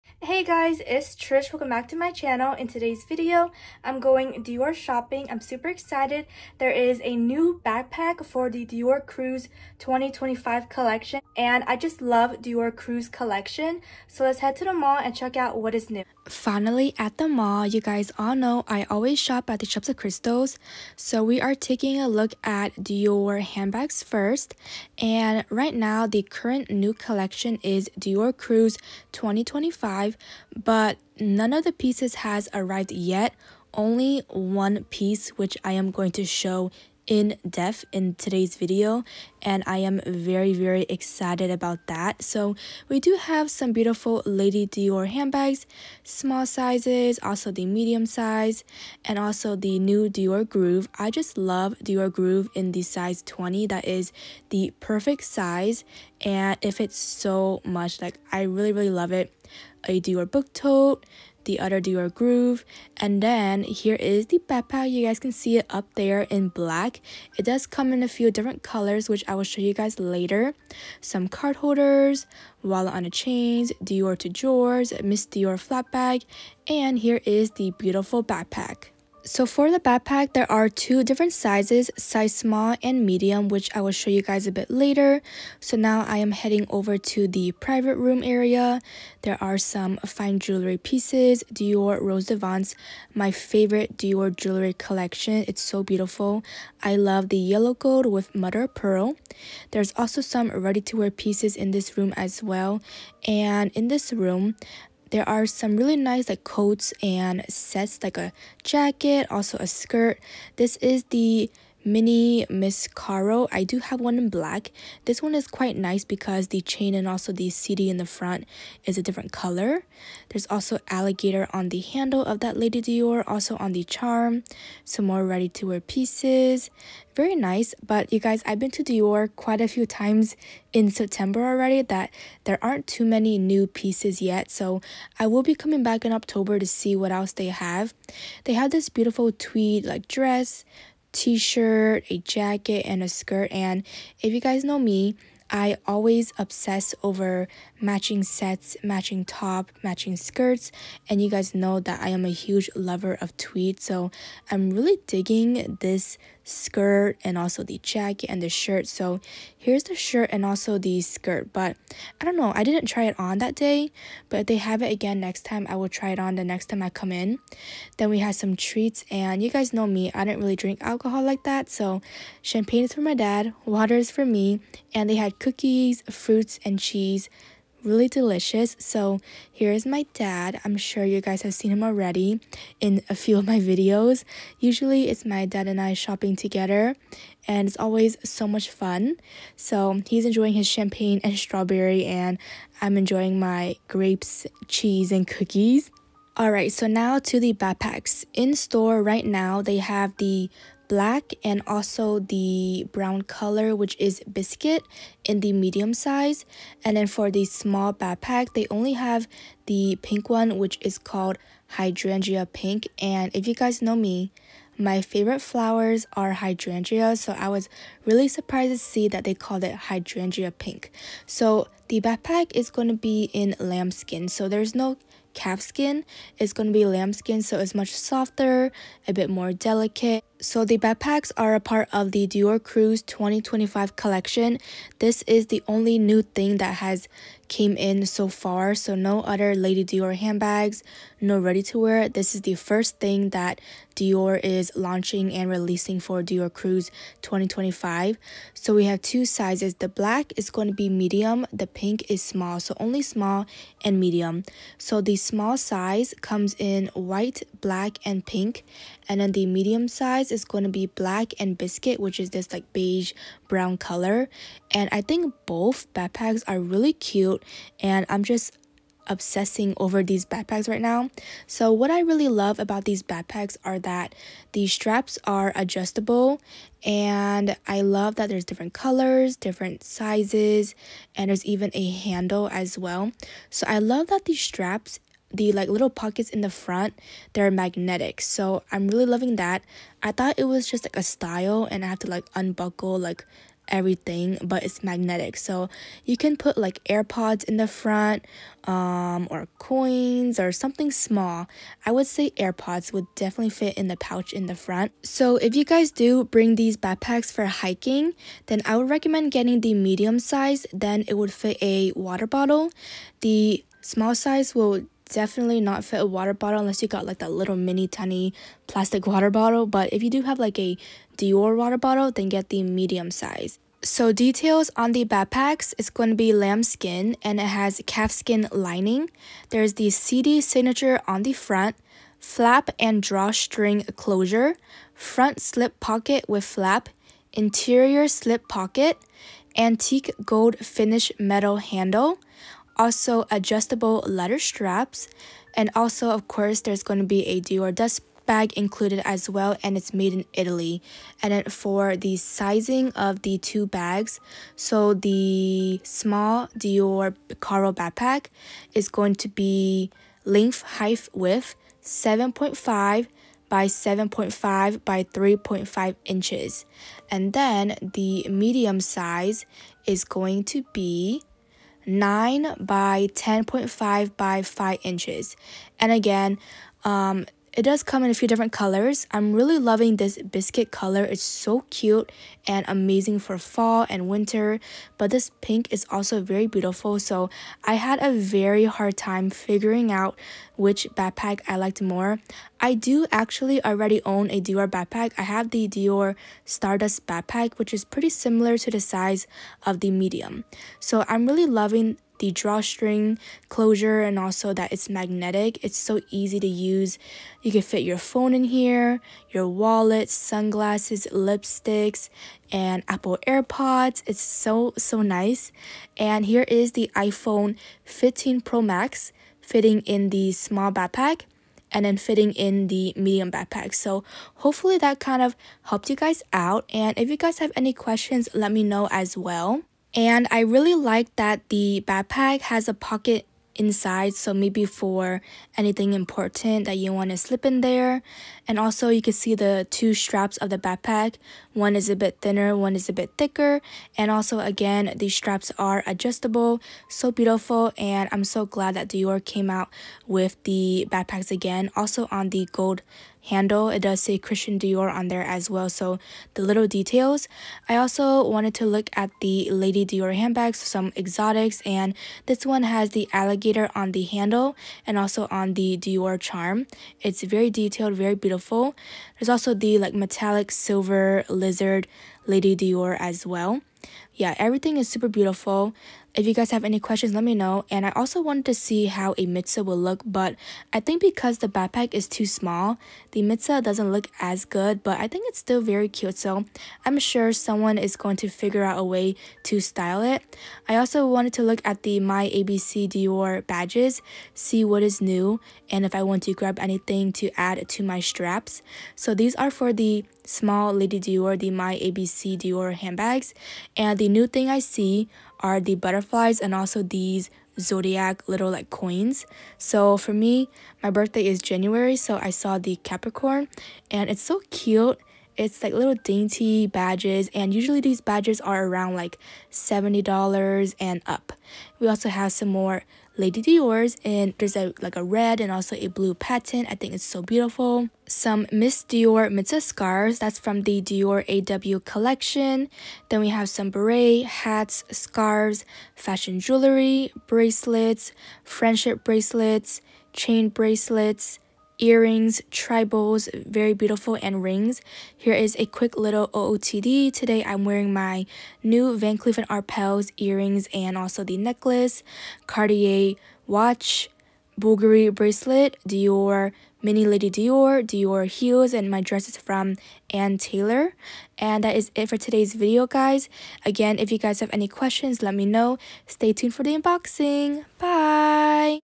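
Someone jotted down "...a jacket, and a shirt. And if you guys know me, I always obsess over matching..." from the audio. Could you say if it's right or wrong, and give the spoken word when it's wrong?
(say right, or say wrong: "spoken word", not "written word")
wrong: "skirt", not "shirt".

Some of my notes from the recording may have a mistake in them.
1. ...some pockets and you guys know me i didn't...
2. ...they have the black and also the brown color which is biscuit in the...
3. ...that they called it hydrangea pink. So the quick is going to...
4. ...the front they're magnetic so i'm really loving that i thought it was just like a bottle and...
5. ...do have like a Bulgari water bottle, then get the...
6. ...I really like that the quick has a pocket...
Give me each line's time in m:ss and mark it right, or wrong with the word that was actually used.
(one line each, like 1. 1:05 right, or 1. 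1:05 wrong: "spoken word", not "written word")
1. 2:48 wrong: "treats", not "pockets"
2. 3:19 right
3. 3:39 wrong: "backpack", not "quick"
4. 4:46 wrong: "style", not "bottle"
5. 5:20 wrong: "Dior", not "Bulgari"
6. 7:10 wrong: "backpack", not "quick".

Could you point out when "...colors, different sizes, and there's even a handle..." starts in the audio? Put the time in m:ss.
4:38.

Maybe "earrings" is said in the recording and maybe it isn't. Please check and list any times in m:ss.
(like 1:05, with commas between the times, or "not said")
9:01, 9:10.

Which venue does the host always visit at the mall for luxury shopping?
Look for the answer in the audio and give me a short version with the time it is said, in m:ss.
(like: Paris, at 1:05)
Shops of Crystals, at 0:19.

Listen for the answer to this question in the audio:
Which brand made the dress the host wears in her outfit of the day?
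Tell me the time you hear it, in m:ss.
9:20.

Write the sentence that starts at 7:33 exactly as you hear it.
It does say Christian Dior on there as well.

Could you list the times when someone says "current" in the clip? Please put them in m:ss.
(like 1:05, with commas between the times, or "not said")
0:26.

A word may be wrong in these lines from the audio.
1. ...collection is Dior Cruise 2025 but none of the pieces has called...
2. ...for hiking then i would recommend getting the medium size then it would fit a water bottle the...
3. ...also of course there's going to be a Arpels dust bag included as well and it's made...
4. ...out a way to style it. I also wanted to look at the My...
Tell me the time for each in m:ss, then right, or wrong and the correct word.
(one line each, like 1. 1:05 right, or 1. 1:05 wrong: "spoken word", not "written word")
1. 0:26 wrong: "arrived", not "called"
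2. 5:07 right
3. 5:45 wrong: "Dior", not "Arpels"
4. 8:08 right.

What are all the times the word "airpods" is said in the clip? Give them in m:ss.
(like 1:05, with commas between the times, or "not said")
4:56, 5:02, 6:53.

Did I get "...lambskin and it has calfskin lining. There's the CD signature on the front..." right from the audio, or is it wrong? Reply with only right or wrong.
right.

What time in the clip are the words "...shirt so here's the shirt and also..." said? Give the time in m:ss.
2:38.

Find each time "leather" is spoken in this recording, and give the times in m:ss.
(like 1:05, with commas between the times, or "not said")
5:44.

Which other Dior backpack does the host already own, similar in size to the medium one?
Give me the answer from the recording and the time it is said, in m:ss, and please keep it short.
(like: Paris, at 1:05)
Dior Stardust backpack, at 6:35.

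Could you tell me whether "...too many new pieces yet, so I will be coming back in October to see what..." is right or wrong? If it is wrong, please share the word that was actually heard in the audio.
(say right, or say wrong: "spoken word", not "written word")
right.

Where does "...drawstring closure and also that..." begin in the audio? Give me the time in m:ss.
6:42.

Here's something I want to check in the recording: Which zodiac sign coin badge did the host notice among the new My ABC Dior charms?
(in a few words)
Capricorn.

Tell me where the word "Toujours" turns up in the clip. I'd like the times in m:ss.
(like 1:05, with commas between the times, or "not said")
1:14.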